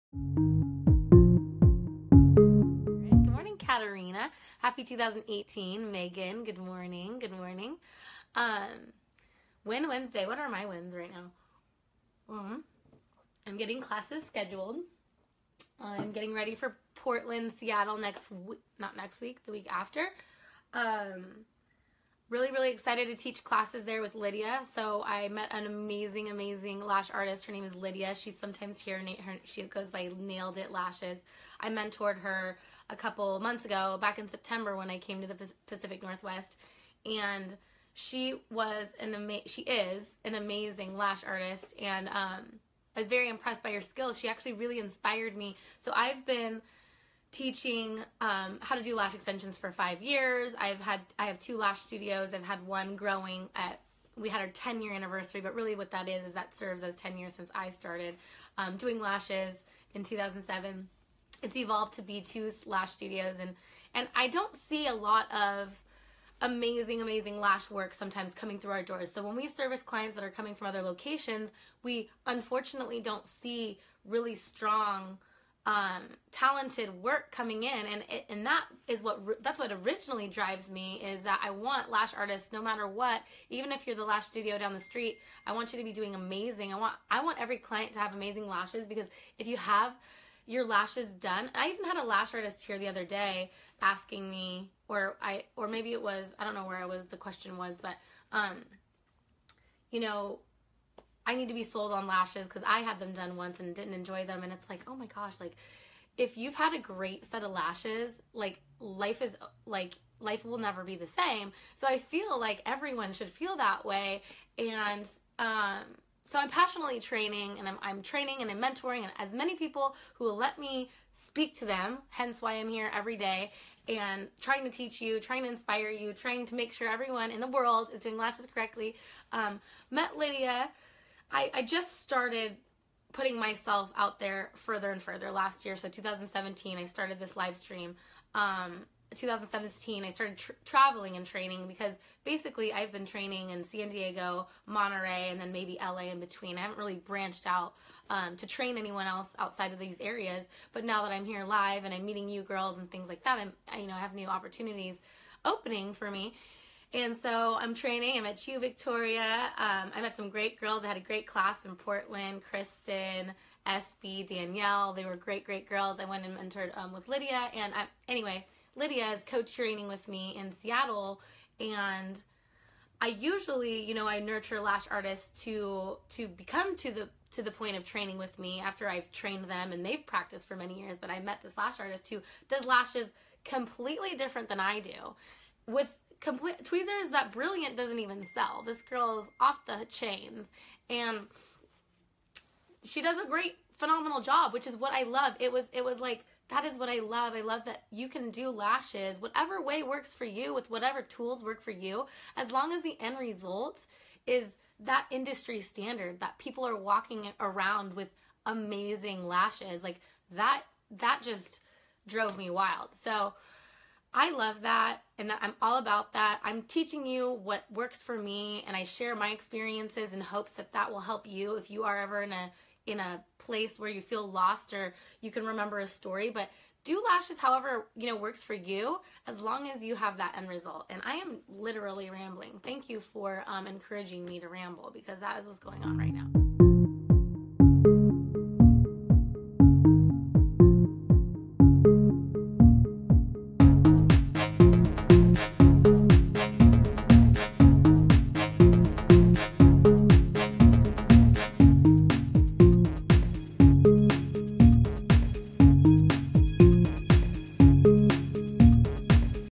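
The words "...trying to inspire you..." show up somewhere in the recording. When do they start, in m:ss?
2:05.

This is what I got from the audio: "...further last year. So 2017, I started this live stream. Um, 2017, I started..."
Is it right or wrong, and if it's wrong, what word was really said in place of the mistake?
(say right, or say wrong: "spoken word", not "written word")
right.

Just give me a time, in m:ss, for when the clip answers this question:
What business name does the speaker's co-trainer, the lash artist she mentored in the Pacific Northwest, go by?
0:30.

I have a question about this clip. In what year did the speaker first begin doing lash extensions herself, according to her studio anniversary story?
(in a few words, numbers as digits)
2007.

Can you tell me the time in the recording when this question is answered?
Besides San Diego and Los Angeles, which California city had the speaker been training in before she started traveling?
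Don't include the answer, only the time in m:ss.
2:24.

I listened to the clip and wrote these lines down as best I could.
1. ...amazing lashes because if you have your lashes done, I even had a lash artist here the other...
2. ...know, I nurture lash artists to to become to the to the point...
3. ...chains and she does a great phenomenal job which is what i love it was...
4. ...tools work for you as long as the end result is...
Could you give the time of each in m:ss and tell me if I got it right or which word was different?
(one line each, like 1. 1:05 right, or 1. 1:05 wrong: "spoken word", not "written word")
1. 1:28 right
2. 2:53 right
3. 3:09 right
4. 3:21 right.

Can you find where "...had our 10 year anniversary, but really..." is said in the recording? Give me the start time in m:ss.
0:54.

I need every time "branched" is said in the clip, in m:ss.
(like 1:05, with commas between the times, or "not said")
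2:26.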